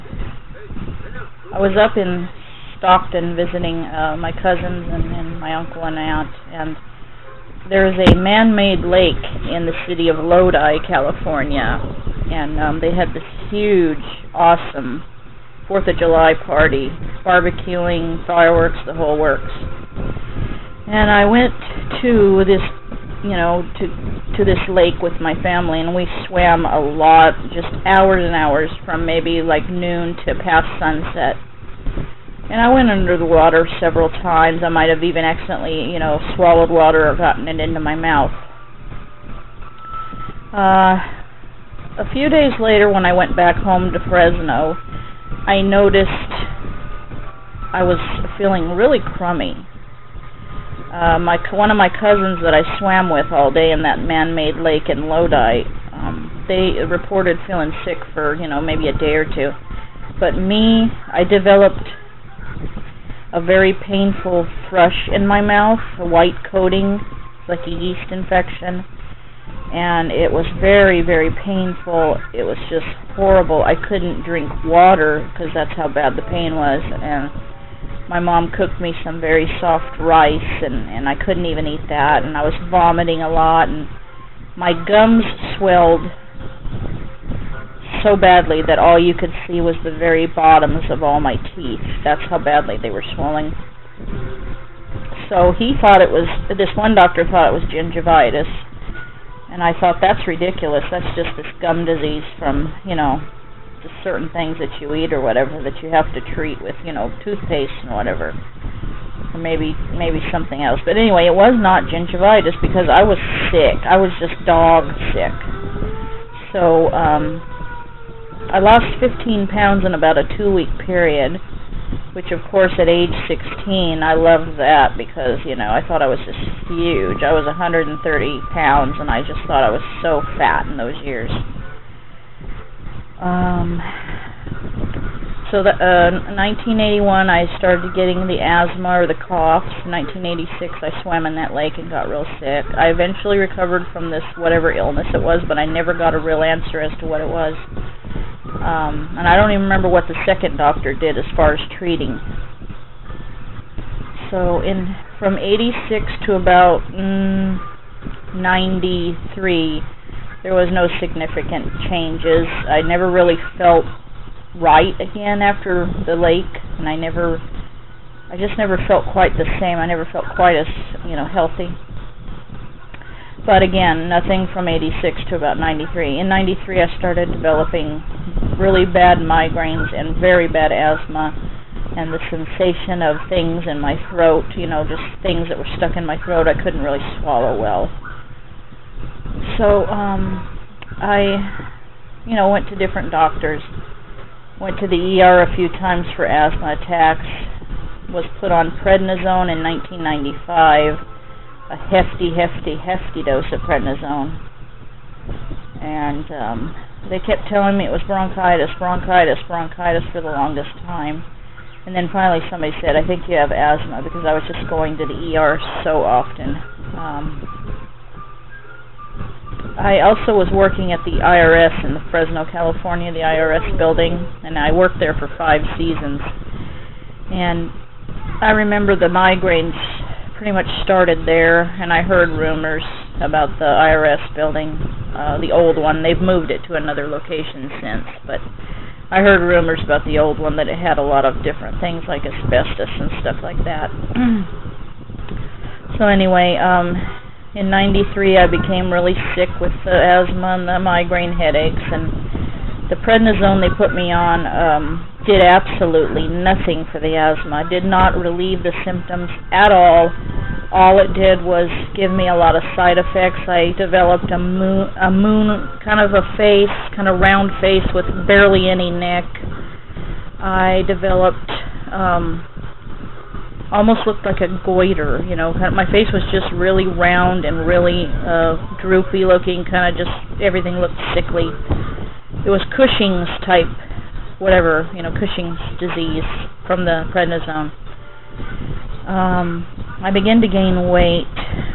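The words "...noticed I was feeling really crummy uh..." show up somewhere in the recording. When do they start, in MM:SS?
00:45.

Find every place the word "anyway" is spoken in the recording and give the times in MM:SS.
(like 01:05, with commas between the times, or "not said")
01:50, 04:06.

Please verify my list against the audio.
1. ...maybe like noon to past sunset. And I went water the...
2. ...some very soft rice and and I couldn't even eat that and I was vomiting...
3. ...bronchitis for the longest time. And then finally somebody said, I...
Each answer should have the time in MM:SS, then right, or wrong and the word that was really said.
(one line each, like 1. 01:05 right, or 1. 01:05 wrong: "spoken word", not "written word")
1. 00:29 wrong: "under", not "water"
2. 01:19 right
3. 03:29 right.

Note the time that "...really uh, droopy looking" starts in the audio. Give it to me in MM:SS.
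04:37.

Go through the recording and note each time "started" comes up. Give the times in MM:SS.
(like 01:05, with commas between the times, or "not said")
02:17, 02:56, 03:50.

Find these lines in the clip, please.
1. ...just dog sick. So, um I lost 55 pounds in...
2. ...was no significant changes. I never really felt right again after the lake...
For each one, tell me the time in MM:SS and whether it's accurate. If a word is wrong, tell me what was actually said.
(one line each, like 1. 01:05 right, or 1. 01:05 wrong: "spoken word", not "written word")
1. 01:54 wrong: "15", not "55"
2. 02:40 right.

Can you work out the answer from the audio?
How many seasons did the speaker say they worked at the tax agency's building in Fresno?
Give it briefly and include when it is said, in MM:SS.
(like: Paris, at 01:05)
5, at 03:45.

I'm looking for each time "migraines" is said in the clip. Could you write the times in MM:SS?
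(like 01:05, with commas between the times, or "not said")
02:59, 03:49, 04:10.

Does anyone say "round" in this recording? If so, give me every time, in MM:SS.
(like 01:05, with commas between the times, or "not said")
04:27, 04:36.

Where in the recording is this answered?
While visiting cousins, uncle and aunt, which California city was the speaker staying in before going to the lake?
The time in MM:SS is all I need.
00:02.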